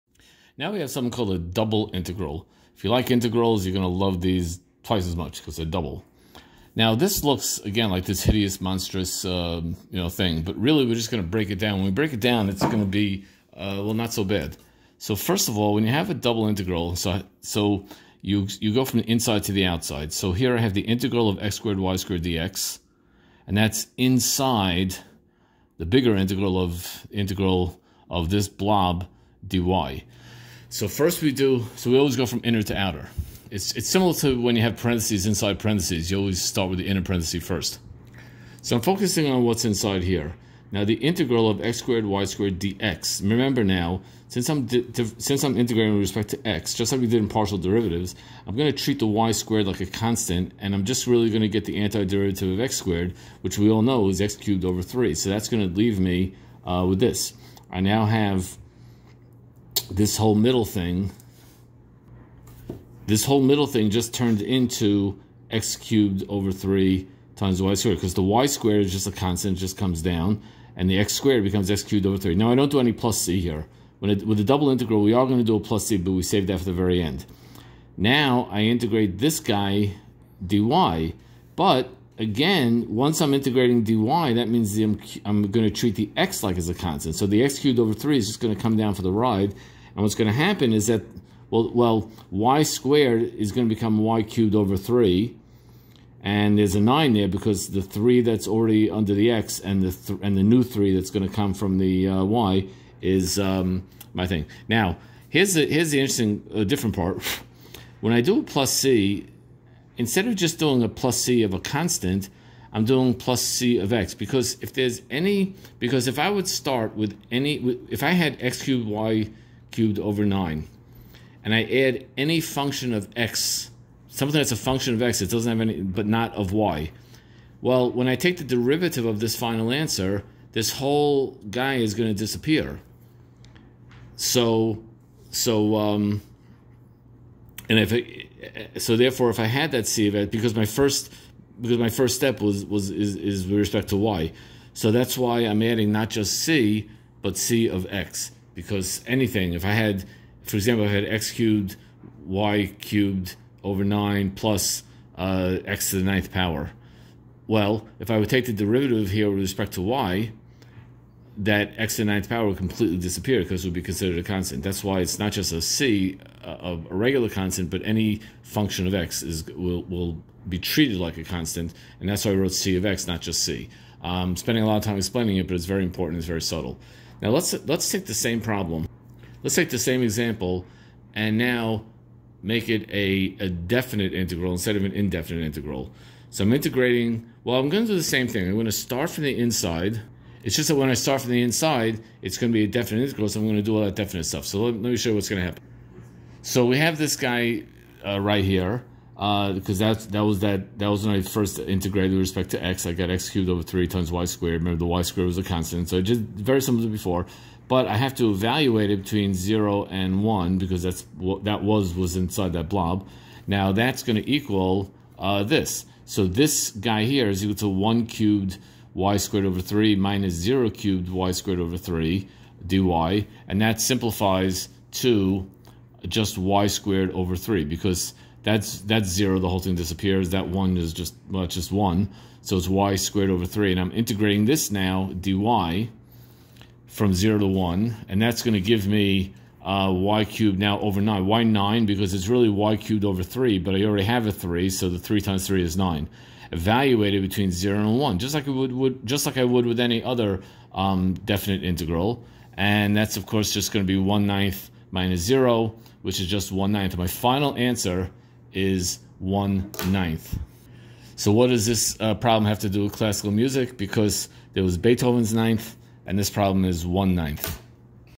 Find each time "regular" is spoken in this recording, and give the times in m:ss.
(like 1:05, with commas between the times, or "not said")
2:46.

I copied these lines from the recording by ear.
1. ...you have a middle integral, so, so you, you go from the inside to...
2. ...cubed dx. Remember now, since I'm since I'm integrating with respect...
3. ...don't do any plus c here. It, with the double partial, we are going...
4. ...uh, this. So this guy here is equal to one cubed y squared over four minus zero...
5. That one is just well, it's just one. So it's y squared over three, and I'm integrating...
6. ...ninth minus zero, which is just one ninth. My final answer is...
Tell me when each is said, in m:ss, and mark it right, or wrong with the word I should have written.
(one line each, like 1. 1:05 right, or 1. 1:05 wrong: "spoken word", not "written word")
1. 0:15 wrong: "double", not "middle"
2. 0:42 wrong: "squared", not "cubed"
3. 1:12 wrong: "integral", not "partial"
4. 3:35 wrong: "three", not "four"
5. 3:50 right
6. 4:14 right.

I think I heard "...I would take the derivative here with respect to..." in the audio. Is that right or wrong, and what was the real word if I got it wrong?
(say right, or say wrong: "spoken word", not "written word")
right.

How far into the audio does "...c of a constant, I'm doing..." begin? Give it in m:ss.
1:51.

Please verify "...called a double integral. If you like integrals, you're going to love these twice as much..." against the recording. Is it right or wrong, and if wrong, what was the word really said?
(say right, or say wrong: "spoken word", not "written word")
right.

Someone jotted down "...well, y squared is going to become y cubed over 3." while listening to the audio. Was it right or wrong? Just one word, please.
right.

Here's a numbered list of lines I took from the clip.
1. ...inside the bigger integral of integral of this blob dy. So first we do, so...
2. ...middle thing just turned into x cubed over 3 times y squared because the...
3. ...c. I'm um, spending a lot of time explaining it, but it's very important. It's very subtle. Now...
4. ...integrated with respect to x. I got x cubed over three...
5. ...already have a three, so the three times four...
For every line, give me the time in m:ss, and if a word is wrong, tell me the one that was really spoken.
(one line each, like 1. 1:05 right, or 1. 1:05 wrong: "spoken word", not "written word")
1. 0:23 right
2. 1:03 right
3. 2:53 right
4. 3:21 right
5. 4:03 wrong: "three", not "four".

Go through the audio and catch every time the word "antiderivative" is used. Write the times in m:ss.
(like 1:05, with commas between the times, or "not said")
0:51.